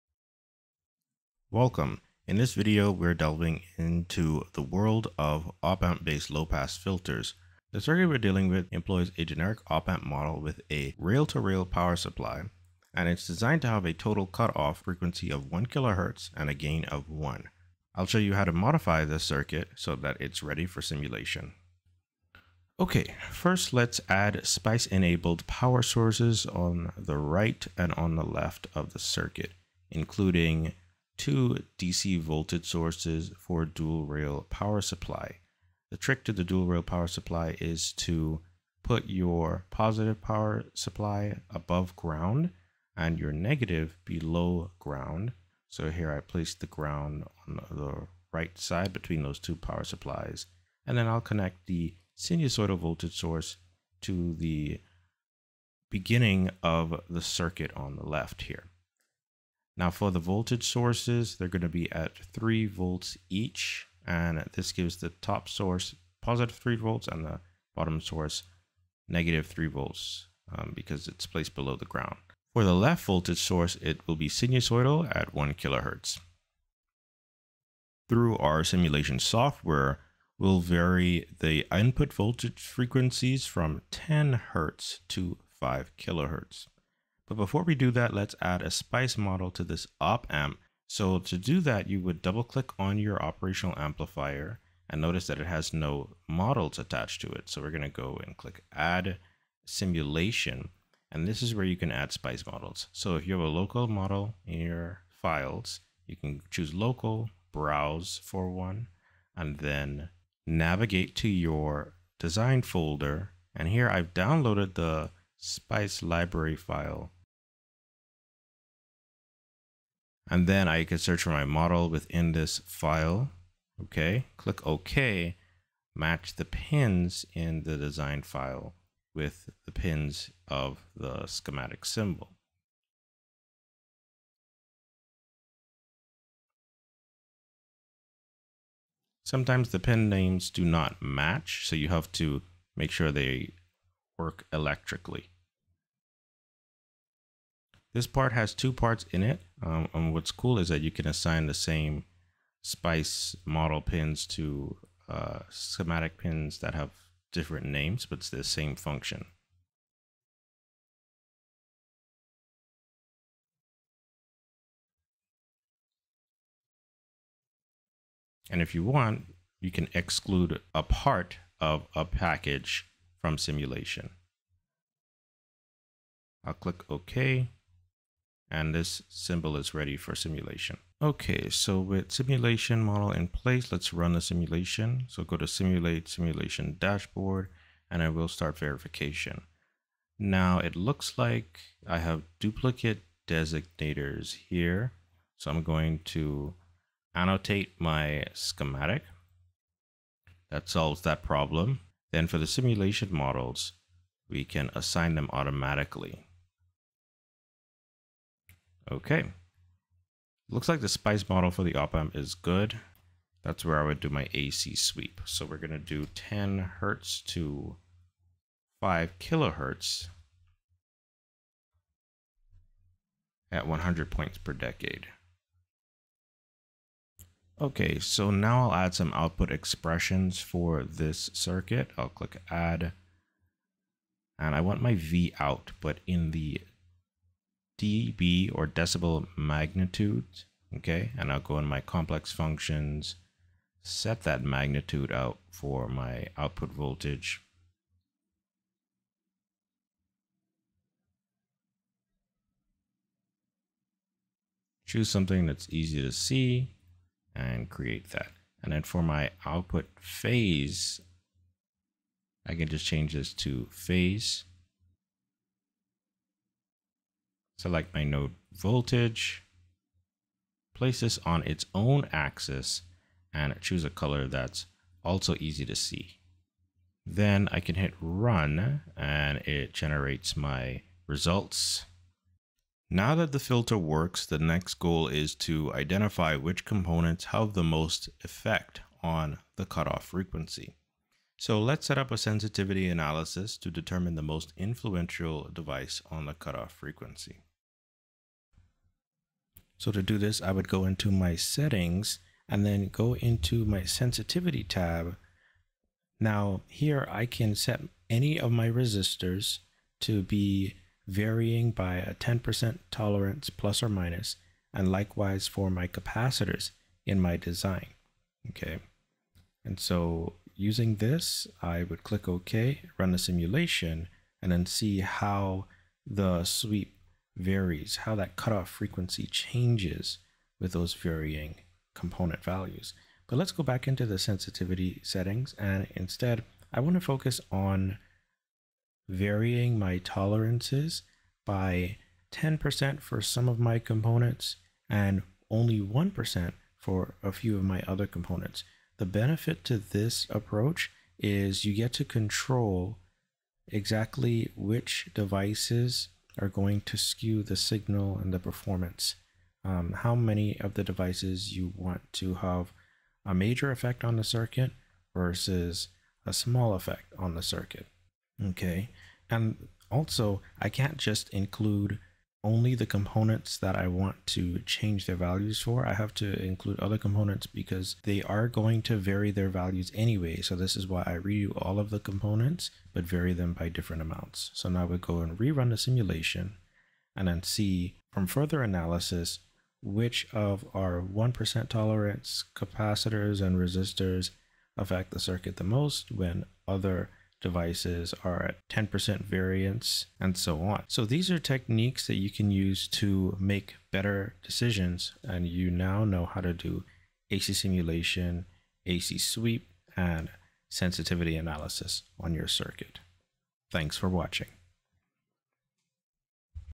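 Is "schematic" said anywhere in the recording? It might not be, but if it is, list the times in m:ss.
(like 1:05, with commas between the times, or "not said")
2:11, 2:35, 3:18.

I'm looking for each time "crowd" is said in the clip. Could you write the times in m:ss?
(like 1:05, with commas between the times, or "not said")
not said.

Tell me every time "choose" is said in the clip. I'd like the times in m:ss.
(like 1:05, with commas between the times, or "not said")
1:46, 4:14, 4:33.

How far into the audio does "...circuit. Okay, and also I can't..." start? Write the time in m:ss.
6:07.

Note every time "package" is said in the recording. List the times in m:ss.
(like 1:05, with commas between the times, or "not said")
2:52.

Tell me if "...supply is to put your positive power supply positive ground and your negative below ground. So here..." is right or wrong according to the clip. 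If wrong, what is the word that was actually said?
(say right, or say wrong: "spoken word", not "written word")
wrong: "above", not "positive".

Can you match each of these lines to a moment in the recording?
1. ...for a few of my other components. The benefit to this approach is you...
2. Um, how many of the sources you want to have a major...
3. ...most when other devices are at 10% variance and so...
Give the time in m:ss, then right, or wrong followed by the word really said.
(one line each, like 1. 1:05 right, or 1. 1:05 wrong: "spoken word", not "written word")
1. 5:46 right
2. 5:59 wrong: "devices", not "sources"
3. 6:35 right.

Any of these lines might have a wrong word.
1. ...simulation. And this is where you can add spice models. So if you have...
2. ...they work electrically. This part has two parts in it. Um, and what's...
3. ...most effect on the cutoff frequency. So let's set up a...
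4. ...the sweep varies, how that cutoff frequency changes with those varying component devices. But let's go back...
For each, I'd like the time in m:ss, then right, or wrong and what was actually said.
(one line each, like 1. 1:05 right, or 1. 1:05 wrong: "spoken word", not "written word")
1. 1:39 right
2. 2:23 right
3. 4:47 right
4. 5:26 wrong: "values", not "devices".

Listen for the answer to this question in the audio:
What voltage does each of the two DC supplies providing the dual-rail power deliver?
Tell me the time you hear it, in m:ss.
1:02.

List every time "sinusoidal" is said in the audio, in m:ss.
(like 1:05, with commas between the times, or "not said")
0:52, 1:14.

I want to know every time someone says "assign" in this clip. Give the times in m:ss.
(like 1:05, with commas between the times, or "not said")
2:31, 3:24.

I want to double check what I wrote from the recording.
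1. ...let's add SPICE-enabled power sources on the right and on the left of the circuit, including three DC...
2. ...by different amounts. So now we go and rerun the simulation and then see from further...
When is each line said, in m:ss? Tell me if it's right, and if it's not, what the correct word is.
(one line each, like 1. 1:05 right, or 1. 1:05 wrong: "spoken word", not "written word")
1. 0:23 wrong: "two", not "three"
2. 6:23 right.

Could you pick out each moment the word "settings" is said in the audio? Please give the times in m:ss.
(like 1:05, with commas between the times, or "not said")
5:01, 5:35.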